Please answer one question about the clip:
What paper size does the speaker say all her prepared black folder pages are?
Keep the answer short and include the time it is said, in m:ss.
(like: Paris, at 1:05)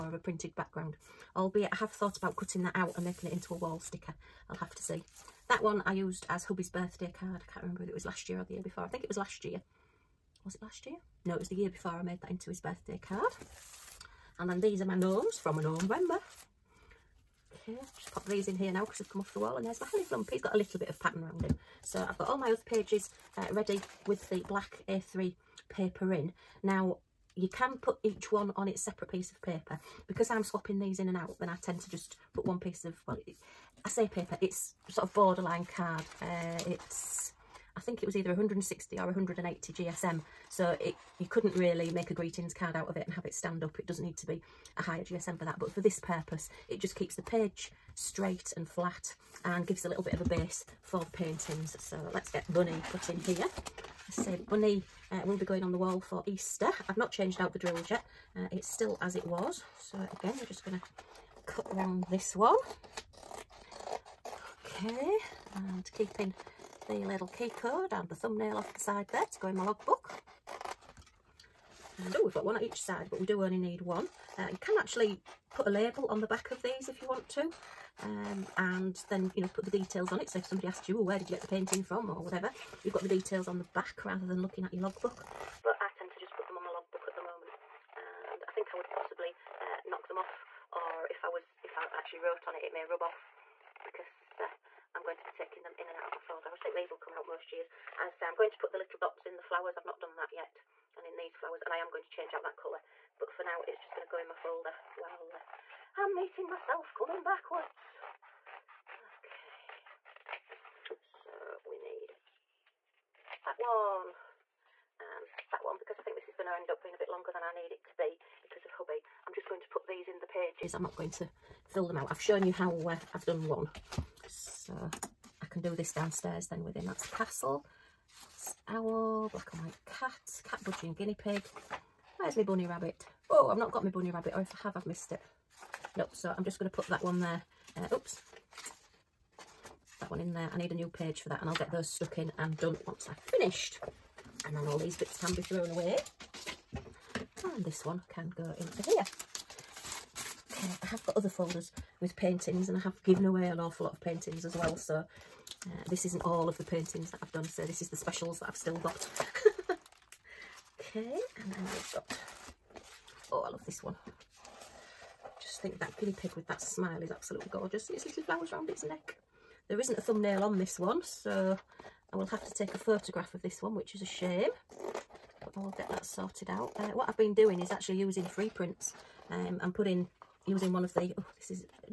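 A3, at 0:24.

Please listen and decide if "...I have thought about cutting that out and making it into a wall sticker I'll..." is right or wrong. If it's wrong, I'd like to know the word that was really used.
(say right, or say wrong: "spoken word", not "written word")
right.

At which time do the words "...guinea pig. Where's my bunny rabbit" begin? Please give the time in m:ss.
2:10.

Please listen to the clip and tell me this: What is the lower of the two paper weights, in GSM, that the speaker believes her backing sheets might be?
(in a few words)
160.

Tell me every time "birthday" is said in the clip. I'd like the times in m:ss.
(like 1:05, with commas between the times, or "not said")
0:06, 0:12.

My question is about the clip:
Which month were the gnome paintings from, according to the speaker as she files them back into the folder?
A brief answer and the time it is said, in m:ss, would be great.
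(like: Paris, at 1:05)
November, at 0:15.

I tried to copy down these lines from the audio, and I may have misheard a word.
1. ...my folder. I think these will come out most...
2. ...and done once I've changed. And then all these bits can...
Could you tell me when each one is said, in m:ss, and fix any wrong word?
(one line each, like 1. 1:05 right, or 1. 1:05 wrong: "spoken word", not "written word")
1. 1:36 right
2. 2:22 wrong: "finished", not "changed".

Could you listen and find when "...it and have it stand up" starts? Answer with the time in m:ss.
0:42.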